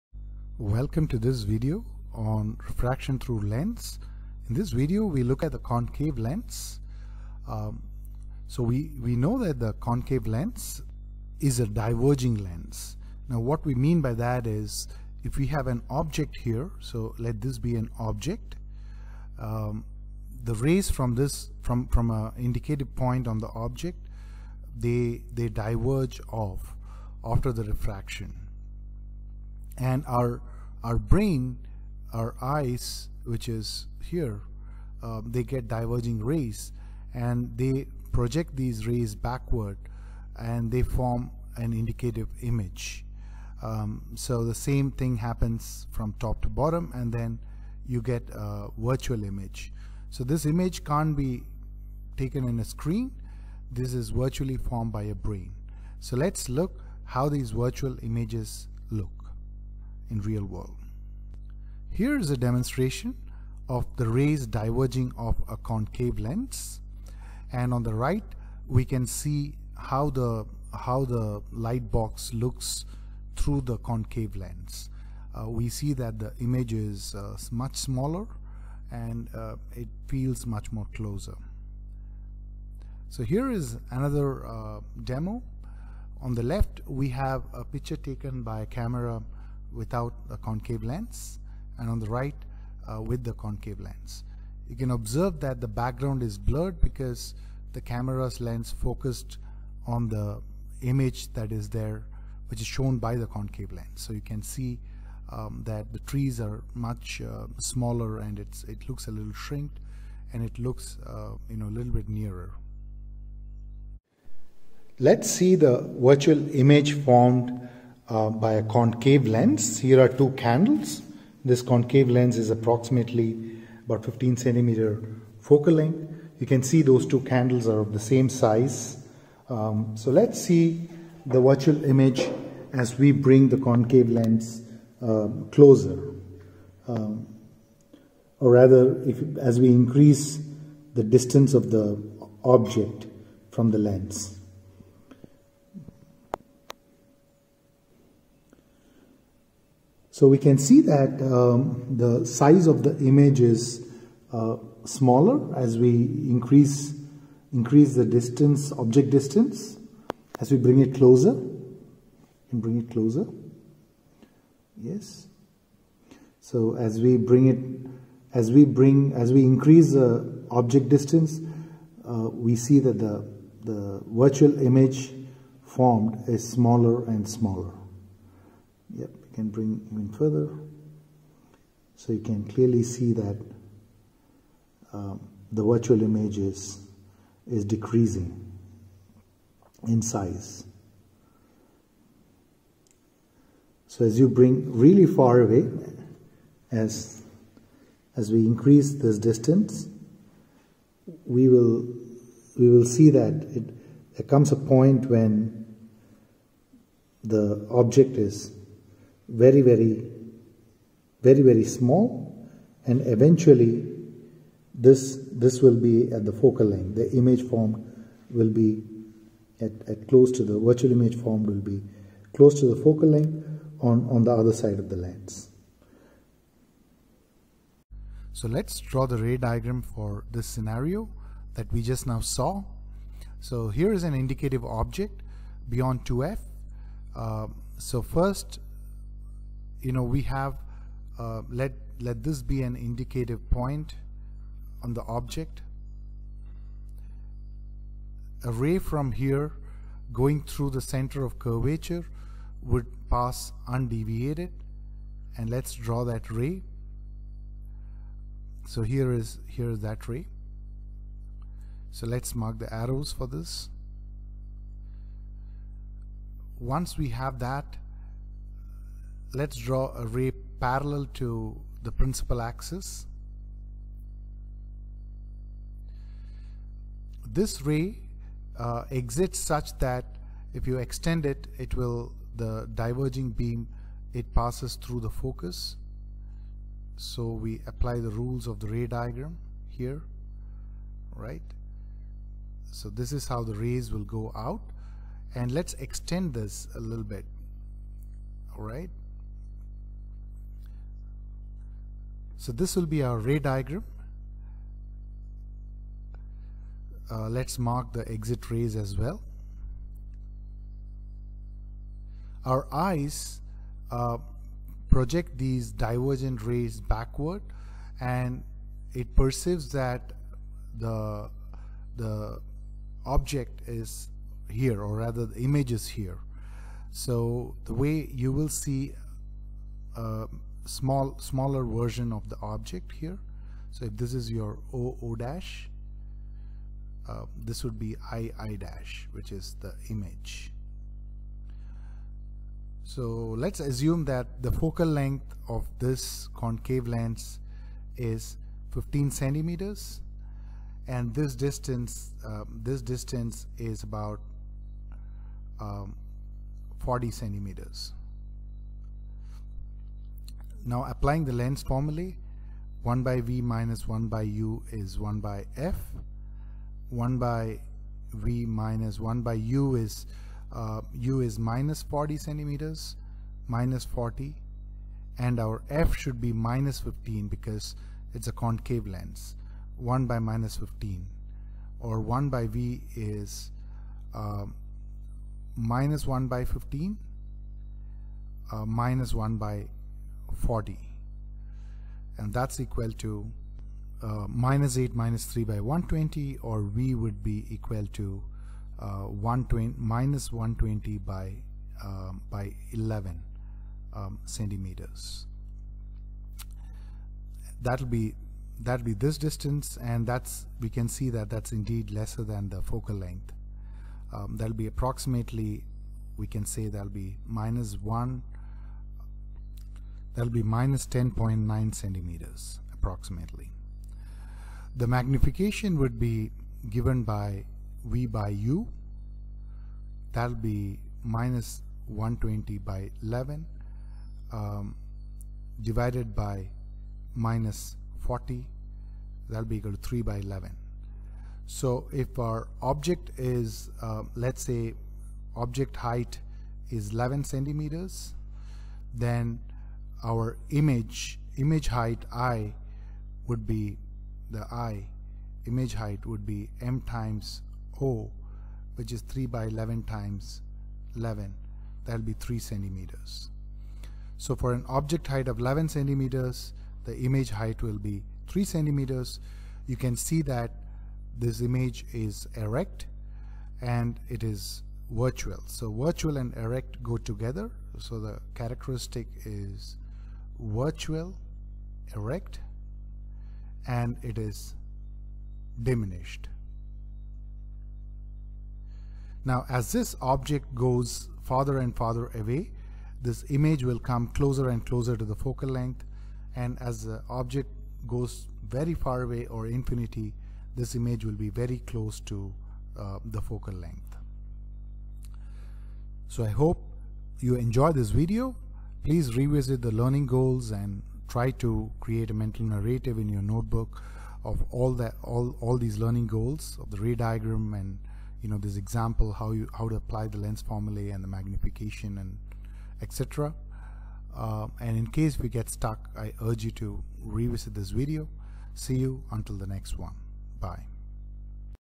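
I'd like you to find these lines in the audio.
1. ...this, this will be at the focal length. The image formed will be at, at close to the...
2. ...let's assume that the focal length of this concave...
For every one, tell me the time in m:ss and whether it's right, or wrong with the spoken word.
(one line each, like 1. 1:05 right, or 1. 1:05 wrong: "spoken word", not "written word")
1. 3:34 right
2. 5:43 right.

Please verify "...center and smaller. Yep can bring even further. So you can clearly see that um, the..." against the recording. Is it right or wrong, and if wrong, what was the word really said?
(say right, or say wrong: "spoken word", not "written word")
wrong: "smaller", not "center".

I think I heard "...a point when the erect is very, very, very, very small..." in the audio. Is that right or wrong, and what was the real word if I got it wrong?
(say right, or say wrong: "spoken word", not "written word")
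wrong: "object", not "erect".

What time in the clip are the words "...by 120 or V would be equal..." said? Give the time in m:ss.
6:35.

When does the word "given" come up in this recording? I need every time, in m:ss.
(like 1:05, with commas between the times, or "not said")
7:06.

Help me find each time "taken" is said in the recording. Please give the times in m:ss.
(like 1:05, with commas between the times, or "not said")
0:52, 1:27.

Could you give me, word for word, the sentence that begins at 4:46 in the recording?
So we apply the rules of the ray diagram here, right?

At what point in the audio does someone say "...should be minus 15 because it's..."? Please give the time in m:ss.
6:15.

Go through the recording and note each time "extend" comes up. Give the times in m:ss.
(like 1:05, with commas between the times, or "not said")
4:40, 4:55.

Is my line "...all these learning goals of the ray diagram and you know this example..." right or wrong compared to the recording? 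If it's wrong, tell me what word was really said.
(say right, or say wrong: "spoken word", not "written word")
right.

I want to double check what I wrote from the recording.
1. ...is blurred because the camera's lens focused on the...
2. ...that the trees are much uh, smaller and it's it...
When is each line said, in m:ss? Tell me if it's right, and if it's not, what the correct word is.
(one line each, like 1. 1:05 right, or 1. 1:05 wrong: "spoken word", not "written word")
1. 1:36 right
2. 1:45 right.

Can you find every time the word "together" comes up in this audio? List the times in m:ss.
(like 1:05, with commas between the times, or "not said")
7:56.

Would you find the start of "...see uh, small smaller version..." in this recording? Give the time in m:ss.
5:28.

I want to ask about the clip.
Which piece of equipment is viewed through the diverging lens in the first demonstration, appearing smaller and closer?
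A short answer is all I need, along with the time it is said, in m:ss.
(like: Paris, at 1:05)
light box, at 1:11.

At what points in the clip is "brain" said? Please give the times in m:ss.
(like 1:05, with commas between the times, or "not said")
0:30, 0:55.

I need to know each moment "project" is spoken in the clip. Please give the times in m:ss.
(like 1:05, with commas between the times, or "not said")
0:38, 5:14.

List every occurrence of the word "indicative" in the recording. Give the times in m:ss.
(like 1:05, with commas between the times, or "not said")
0:22, 0:41, 3:54, 4:02.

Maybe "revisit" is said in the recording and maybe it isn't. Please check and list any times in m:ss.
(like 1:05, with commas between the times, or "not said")
8:29, 8:47.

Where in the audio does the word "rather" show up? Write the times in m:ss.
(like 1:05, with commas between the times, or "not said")
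2:18, 5:24.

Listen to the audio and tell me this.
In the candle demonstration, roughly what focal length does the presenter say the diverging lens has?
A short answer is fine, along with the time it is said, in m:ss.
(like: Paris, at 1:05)
15 centimeters, at 2:04.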